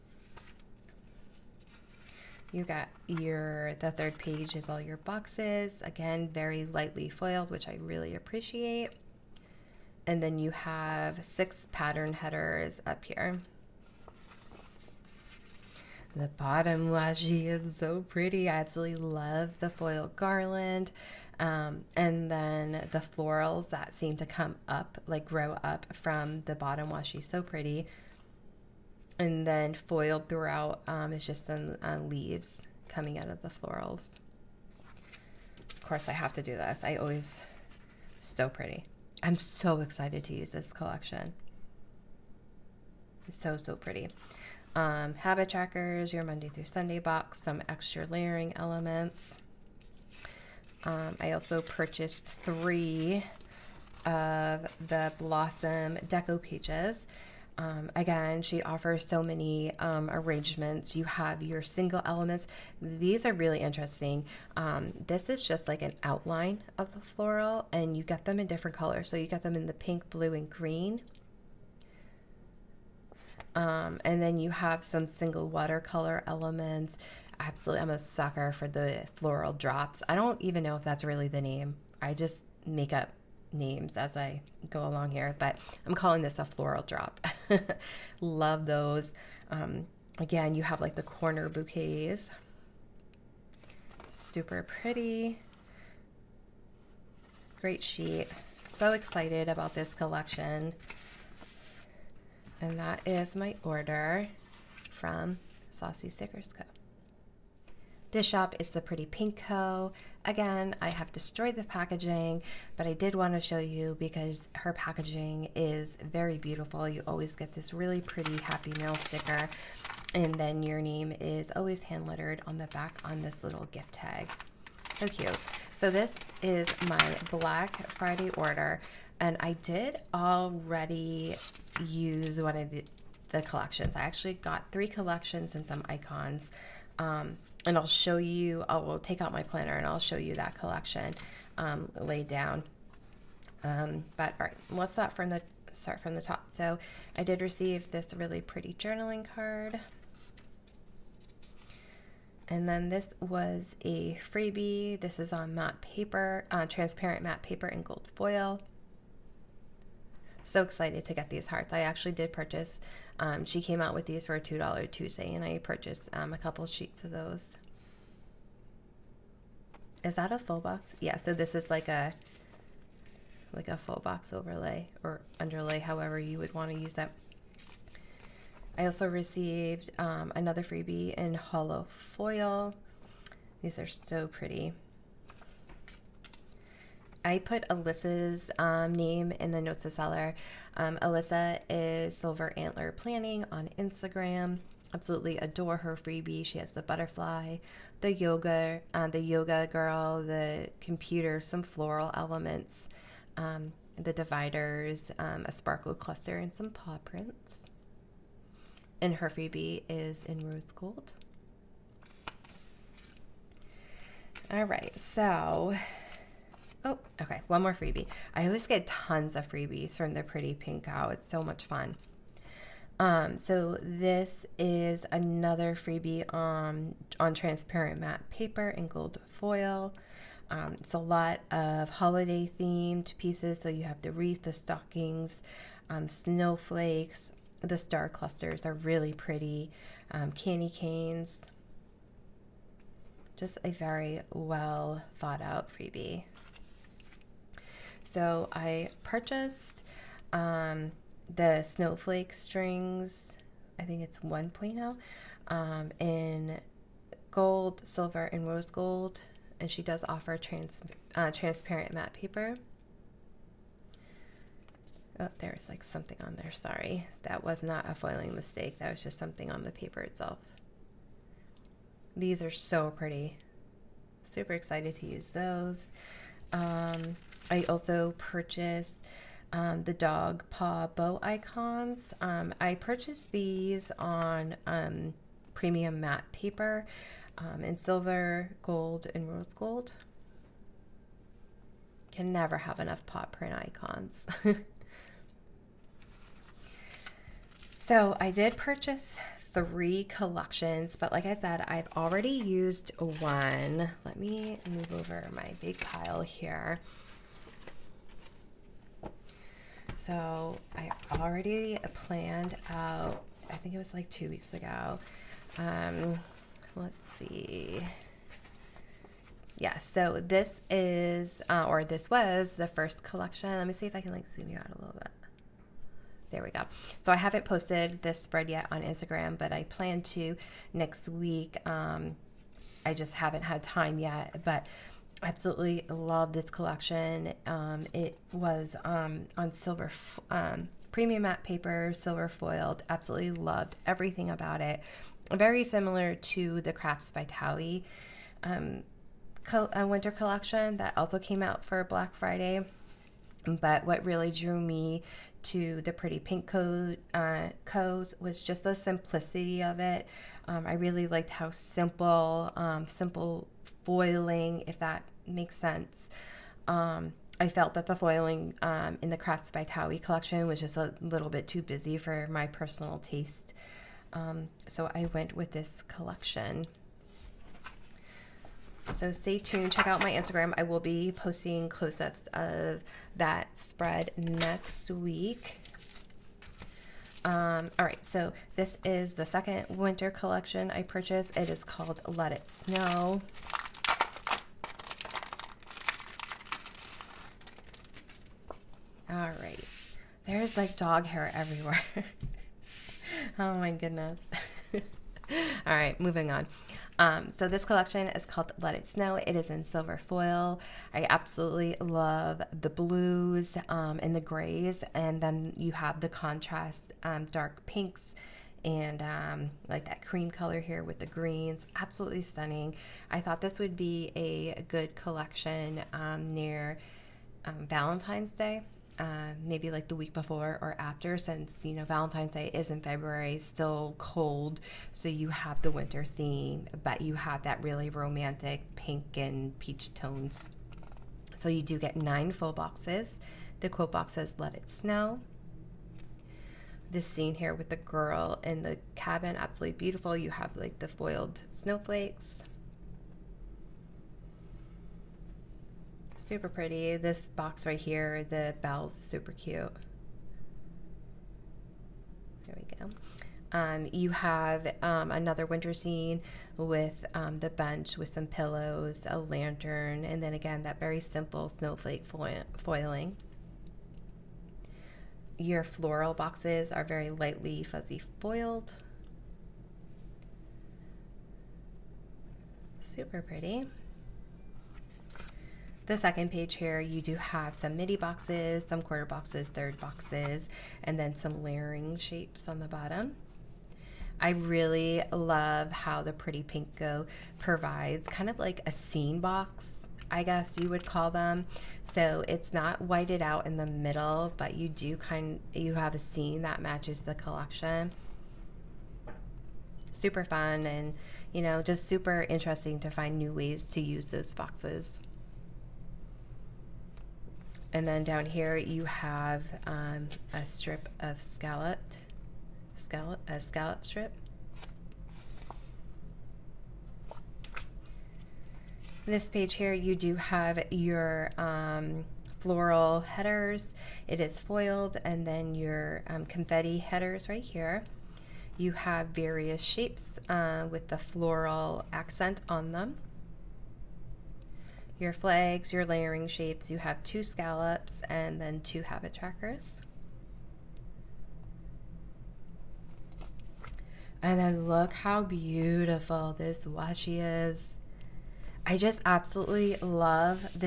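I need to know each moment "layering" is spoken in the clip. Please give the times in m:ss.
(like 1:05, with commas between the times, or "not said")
0:48, 8:11, 9:05.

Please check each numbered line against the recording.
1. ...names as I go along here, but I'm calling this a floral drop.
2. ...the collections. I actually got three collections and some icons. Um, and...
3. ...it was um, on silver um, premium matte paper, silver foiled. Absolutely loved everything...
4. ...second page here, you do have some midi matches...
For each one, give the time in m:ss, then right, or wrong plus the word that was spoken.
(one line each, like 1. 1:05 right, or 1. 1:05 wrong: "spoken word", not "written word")
1. 1:23 right
2. 2:13 right
3. 5:37 right
4. 8:05 wrong: "boxes", not "matches".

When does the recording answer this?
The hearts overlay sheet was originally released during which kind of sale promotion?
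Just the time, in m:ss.
2:44.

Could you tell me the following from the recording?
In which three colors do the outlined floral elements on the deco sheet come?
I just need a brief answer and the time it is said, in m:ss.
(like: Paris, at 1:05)
pink, blue, and green, at 1:09.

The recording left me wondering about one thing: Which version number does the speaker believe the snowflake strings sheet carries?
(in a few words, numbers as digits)
1.0.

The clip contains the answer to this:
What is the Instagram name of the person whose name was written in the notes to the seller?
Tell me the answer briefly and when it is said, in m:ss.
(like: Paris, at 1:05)
Silver Antler Planning, at 3:12.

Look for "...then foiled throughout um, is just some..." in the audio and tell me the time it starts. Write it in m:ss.
0:29.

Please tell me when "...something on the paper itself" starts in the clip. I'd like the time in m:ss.
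4:29.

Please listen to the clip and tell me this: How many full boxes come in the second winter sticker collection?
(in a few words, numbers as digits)
9.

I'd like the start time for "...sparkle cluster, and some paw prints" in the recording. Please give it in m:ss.
3:25.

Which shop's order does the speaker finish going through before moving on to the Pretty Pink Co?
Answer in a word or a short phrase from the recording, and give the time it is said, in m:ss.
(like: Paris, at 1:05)
Saucy Stickers Co, at 1:45.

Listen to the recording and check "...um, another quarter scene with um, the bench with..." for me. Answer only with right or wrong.
wrong.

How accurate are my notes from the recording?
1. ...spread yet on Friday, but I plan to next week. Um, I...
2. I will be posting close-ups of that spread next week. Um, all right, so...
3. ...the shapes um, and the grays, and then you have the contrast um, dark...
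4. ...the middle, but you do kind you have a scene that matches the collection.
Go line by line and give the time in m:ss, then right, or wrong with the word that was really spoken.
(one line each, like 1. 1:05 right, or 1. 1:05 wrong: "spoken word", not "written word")
1. 5:28 wrong: "Instagram", not "Friday"
2. 6:20 right
3. 6:52 wrong: "blues", not "shapes"
4. 8:23 right.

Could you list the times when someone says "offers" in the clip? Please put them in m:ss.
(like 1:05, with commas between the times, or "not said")
0:58, 4:20.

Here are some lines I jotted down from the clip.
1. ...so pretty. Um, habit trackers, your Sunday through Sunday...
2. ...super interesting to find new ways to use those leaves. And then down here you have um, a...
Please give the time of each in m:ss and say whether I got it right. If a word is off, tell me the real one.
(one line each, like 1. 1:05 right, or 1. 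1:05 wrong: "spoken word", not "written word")
1. 0:43 wrong: "Monday", not "Sunday"
2. 8:31 wrong: "boxes", not "leaves".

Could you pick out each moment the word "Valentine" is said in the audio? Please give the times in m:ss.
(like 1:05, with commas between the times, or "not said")
7:07, 7:11.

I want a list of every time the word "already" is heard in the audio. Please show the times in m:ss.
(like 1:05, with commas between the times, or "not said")
2:10, 5:01, 5:11.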